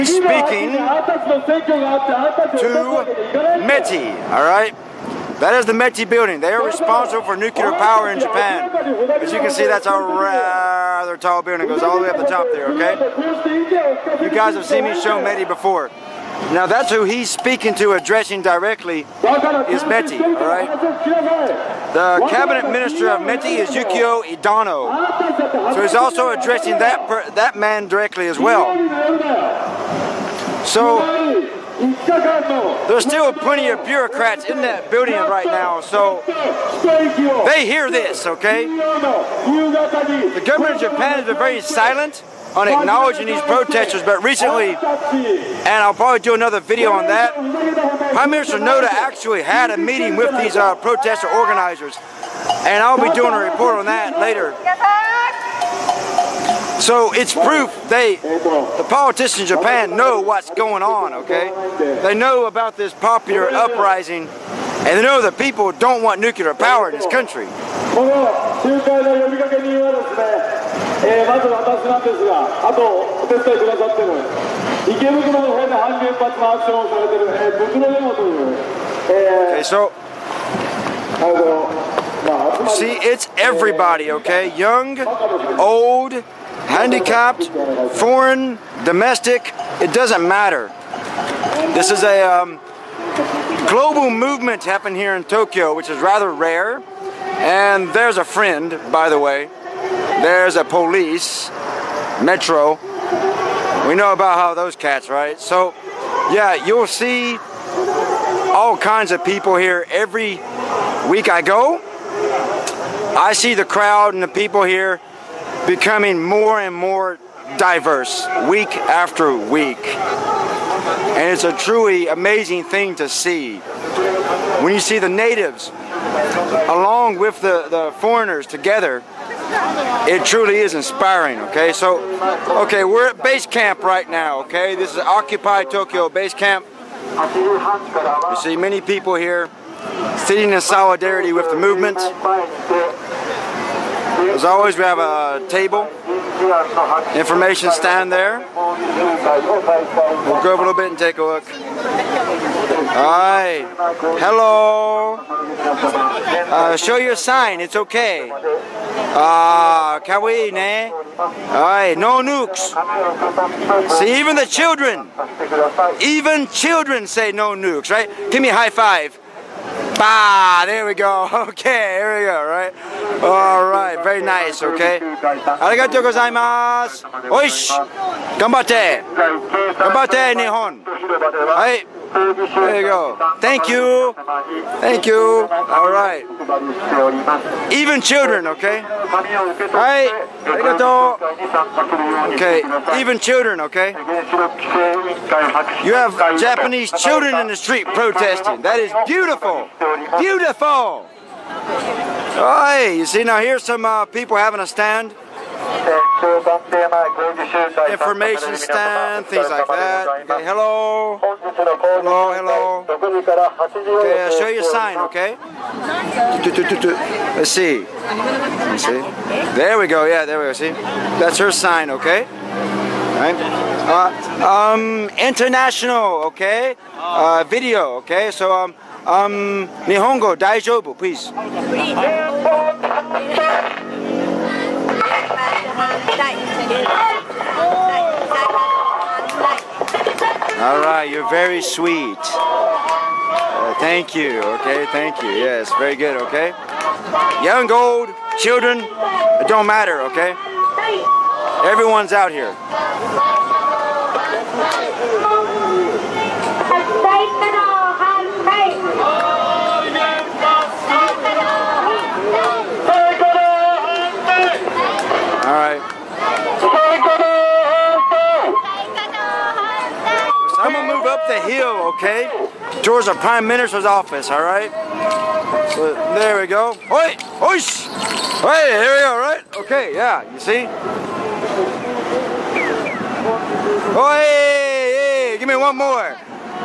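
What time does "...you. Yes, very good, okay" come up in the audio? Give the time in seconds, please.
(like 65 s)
245 s.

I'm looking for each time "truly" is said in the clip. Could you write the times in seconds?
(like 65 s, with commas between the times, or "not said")
121 s, 130 s.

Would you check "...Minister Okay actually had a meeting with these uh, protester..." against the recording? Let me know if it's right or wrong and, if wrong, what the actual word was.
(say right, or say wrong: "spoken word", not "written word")
wrong: "Noda", not "Okay".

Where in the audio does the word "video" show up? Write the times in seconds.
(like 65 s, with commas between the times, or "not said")
46 s, 227 s.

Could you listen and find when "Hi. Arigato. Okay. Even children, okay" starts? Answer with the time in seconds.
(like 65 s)
188 s.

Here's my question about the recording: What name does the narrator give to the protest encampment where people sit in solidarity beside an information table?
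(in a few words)
Occupy Tokyo base camp.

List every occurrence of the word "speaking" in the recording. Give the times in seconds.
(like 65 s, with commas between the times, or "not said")
0 s, 17 s.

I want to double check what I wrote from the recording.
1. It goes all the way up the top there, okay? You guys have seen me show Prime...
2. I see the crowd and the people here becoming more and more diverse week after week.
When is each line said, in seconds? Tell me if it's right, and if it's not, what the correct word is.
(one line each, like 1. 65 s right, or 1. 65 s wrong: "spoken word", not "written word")
1. 11 s wrong: "METI", not "Prime"
2. 113 s right.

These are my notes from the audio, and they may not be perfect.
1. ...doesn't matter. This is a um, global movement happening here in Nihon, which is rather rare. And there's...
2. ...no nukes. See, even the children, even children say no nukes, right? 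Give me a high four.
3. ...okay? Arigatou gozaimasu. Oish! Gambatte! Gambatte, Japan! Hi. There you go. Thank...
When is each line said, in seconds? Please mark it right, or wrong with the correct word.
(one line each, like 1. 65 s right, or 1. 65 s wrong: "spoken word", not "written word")
1. 89 s wrong: "Tokyo", not "Nihon"
2. 161 s wrong: "five", not "four"
3. 174 s wrong: "Nihon", not "Japan".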